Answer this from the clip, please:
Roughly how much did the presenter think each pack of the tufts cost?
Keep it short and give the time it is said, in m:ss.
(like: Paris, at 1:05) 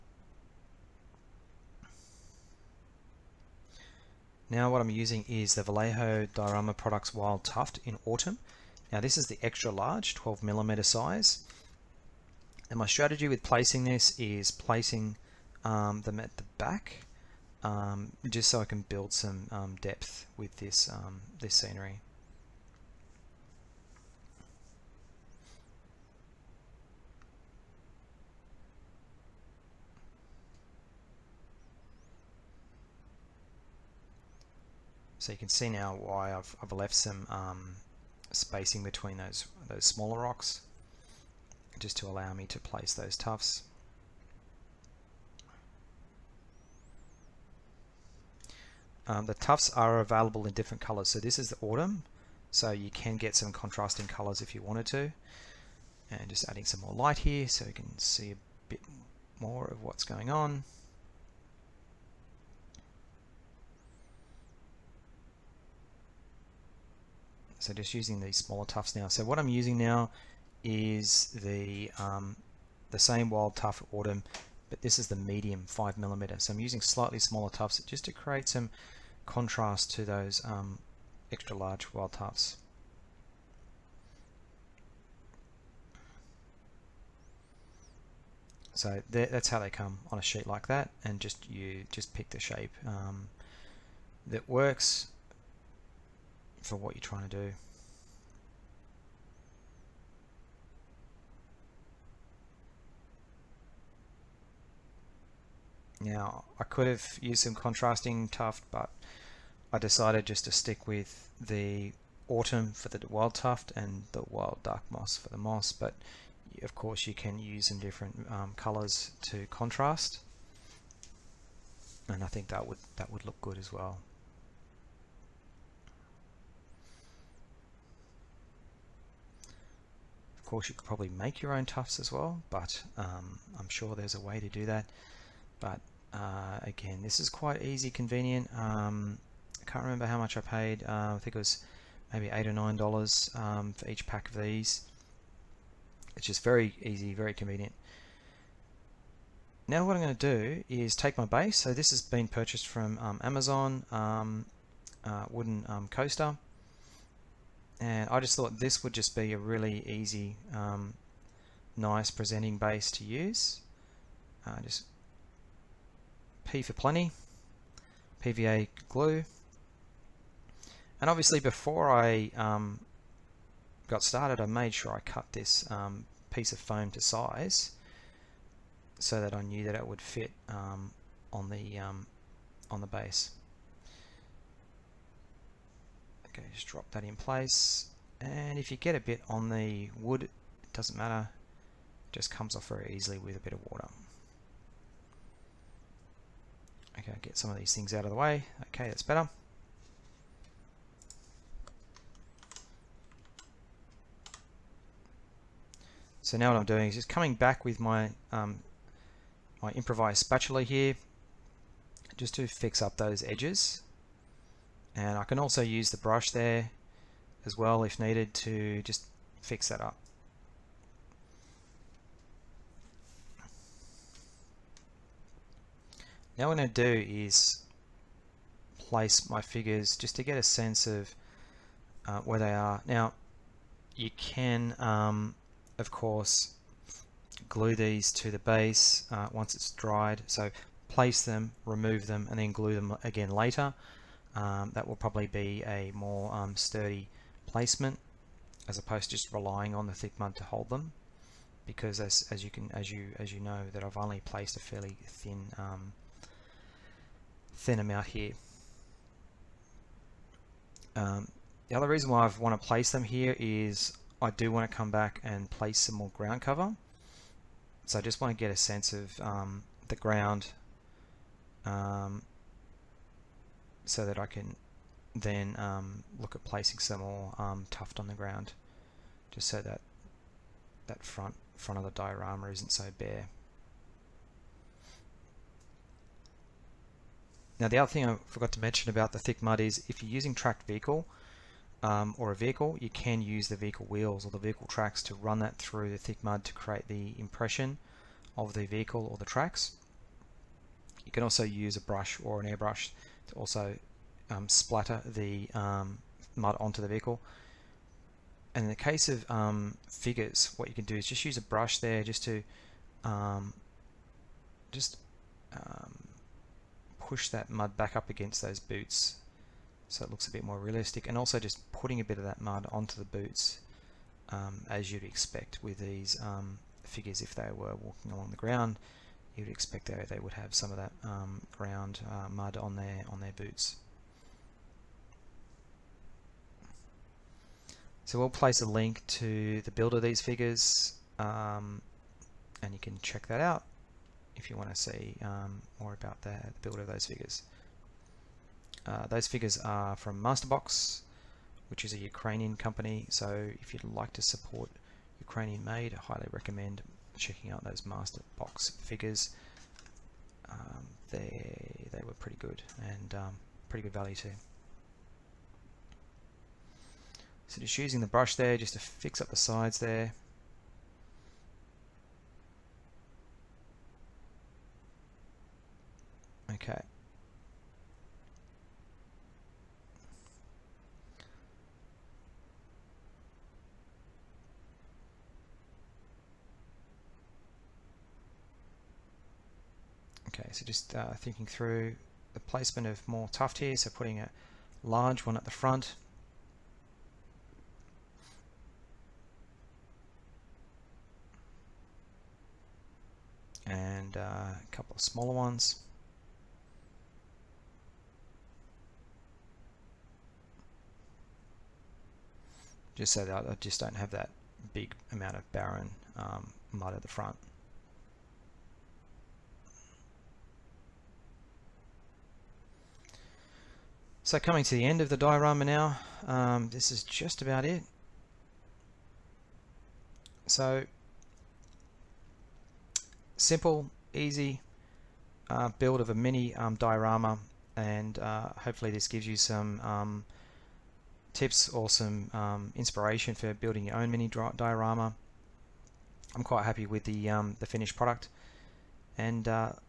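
8 or 9 dollars, at 2:22.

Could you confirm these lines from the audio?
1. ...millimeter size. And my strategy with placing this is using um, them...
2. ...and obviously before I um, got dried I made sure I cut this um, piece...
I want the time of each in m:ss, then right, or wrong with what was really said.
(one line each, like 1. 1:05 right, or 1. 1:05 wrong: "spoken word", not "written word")
1. 0:10 wrong: "placing", not "using"
2. 2:51 wrong: "started", not "dried".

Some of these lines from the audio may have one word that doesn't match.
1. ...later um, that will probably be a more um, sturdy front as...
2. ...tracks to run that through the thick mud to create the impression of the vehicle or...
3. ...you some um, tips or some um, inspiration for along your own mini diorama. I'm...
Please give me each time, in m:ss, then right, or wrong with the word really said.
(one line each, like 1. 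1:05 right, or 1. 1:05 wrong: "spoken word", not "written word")
1. 4:03 wrong: "placement", not "front"
2. 4:54 right
3. 7:19 wrong: "building", not "along".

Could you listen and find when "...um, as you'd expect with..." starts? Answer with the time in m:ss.
5:24.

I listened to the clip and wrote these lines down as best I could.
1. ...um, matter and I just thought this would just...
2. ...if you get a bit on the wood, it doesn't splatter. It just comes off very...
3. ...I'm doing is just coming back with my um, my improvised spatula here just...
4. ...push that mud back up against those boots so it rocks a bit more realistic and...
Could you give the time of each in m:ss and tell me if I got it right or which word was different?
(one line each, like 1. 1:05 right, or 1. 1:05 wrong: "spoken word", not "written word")
1. 2:35 wrong: "coaster", not "matter"
2. 3:08 wrong: "matter", not "splatter"
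3. 3:26 right
4. 5:16 wrong: "looks", not "rocks".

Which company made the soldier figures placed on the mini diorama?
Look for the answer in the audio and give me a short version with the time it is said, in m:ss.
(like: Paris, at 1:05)
Masterbox, at 5:50.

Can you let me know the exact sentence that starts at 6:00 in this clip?
Um, they they were pretty good and um, pretty good value too.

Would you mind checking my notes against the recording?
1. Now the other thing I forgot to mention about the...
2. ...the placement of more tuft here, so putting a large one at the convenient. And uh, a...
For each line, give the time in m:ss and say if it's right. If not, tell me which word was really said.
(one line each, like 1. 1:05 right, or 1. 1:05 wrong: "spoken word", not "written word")
1. 4:47 right
2. 6:32 wrong: "front", not "convenient".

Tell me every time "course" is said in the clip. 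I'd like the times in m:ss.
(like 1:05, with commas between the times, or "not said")
1:56, 2:10, 3:55.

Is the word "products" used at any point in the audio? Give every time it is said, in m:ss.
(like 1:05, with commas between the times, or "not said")
0:06, 7:27.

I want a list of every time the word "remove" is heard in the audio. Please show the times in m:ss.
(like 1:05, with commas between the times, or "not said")
4:01.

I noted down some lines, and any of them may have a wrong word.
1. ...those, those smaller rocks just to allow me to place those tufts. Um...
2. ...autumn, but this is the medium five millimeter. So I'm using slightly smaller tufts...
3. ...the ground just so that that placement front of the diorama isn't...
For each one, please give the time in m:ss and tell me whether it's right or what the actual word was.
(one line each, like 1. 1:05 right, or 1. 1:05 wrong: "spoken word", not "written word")
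1. 0:39 right
2. 1:13 right
3. 4:38 wrong: "front", not "placement".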